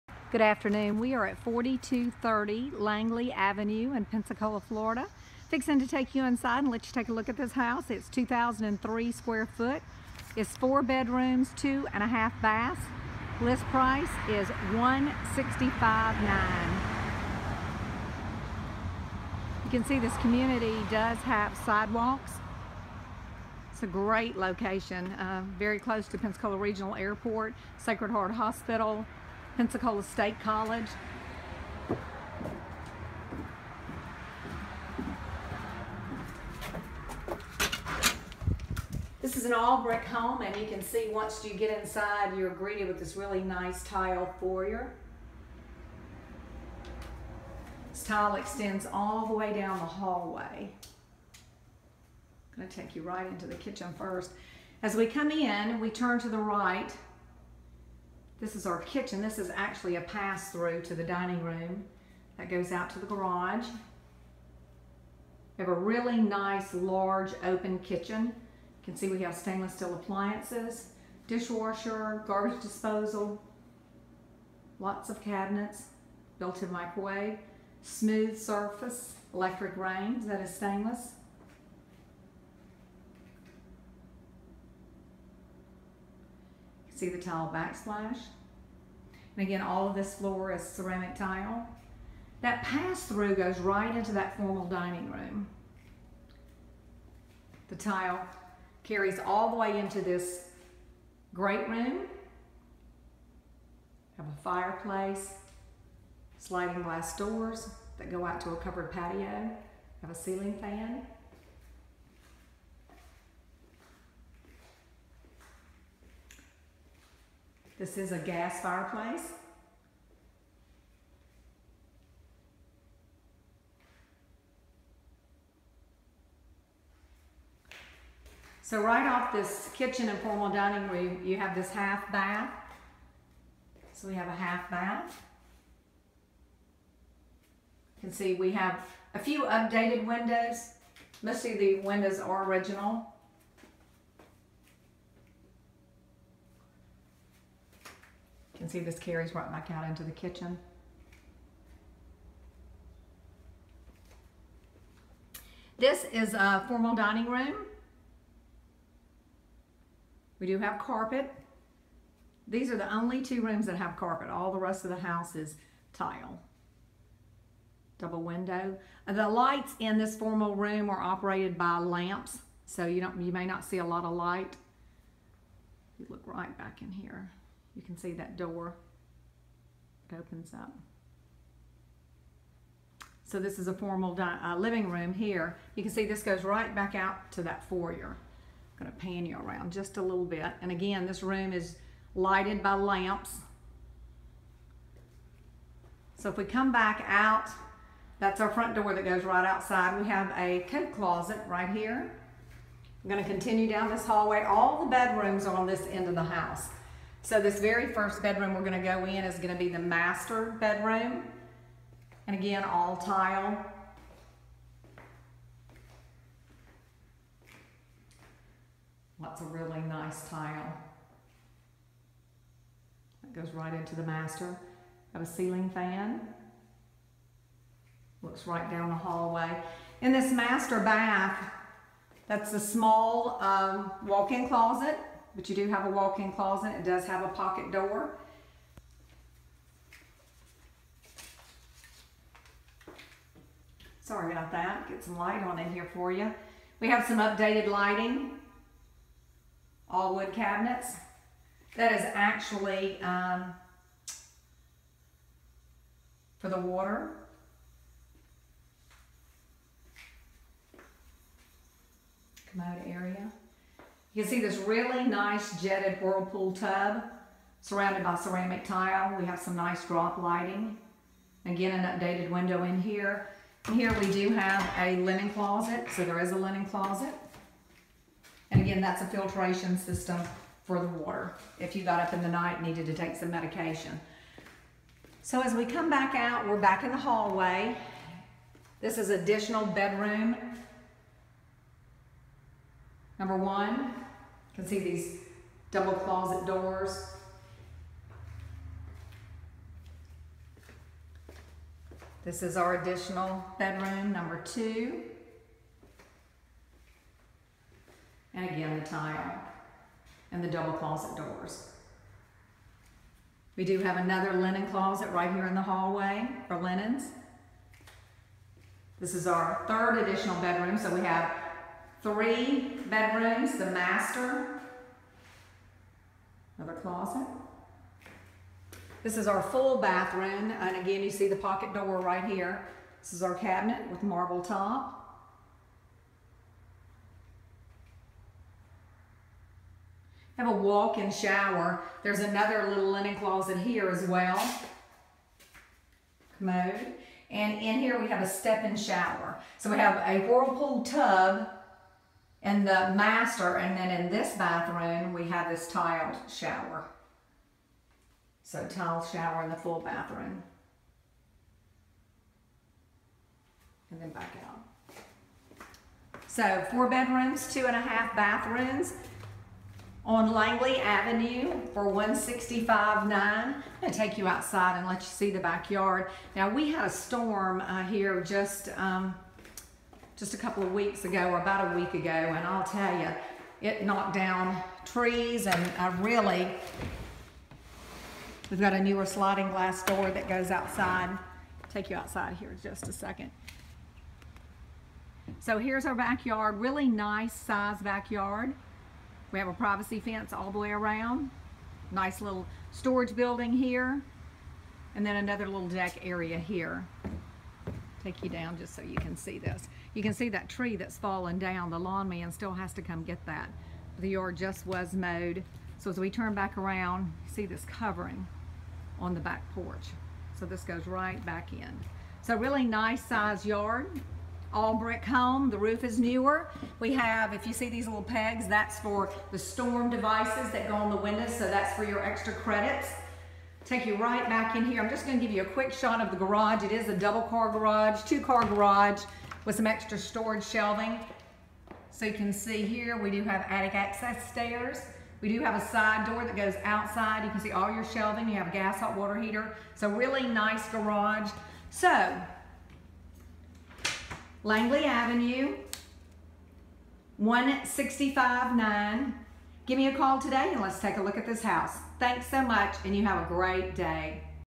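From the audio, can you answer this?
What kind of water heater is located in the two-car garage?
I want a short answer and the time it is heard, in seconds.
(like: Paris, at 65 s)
Gas hot water heater, at 448 s.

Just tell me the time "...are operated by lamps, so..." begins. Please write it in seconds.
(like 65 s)
170 s.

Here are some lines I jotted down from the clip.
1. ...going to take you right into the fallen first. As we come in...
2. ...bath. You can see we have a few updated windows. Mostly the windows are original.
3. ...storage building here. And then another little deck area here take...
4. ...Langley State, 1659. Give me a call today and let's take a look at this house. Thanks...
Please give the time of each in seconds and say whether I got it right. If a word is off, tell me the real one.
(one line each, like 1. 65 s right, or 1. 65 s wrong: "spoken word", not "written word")
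1. 52 s wrong: "kitchen", not "fallen"
2. 134 s right
3. 402 s right
4. 454 s wrong: "Avenue", not "State".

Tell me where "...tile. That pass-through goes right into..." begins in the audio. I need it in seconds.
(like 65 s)
91 s.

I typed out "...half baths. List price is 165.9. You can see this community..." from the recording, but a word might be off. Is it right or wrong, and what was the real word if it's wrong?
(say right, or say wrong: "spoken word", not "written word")
right.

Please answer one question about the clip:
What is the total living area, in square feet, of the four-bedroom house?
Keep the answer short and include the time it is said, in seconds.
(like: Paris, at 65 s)
2,003, at 8 s.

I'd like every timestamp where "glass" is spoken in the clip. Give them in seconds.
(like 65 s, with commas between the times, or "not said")
106 s, 389 s.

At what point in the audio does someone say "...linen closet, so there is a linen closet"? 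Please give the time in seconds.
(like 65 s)
274 s.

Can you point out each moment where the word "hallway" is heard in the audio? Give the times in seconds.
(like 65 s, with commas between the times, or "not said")
49 s, 204 s, 228 s, 286 s, 315 s.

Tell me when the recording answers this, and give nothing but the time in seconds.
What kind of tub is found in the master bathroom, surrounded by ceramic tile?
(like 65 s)
265 s.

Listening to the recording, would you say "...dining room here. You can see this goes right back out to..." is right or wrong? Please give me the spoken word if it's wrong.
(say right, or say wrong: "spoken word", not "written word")
wrong: "living", not "dining".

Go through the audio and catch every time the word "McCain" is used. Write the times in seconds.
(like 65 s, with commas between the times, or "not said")
not said.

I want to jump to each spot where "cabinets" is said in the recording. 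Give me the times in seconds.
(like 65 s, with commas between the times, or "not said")
75 s, 250 s, 333 s.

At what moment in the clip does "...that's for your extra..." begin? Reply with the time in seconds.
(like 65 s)
431 s.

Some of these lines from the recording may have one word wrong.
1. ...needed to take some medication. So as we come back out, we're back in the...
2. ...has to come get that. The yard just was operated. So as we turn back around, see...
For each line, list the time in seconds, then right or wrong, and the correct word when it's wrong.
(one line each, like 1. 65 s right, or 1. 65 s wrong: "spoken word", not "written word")
1. 282 s right
2. 412 s wrong: "mowed", not "operated".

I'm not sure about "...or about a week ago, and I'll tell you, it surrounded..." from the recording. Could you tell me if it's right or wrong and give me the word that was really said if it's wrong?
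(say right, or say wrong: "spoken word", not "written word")
wrong: "knocked", not "surrounded".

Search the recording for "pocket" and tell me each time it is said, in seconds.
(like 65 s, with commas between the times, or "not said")
237 s, 331 s.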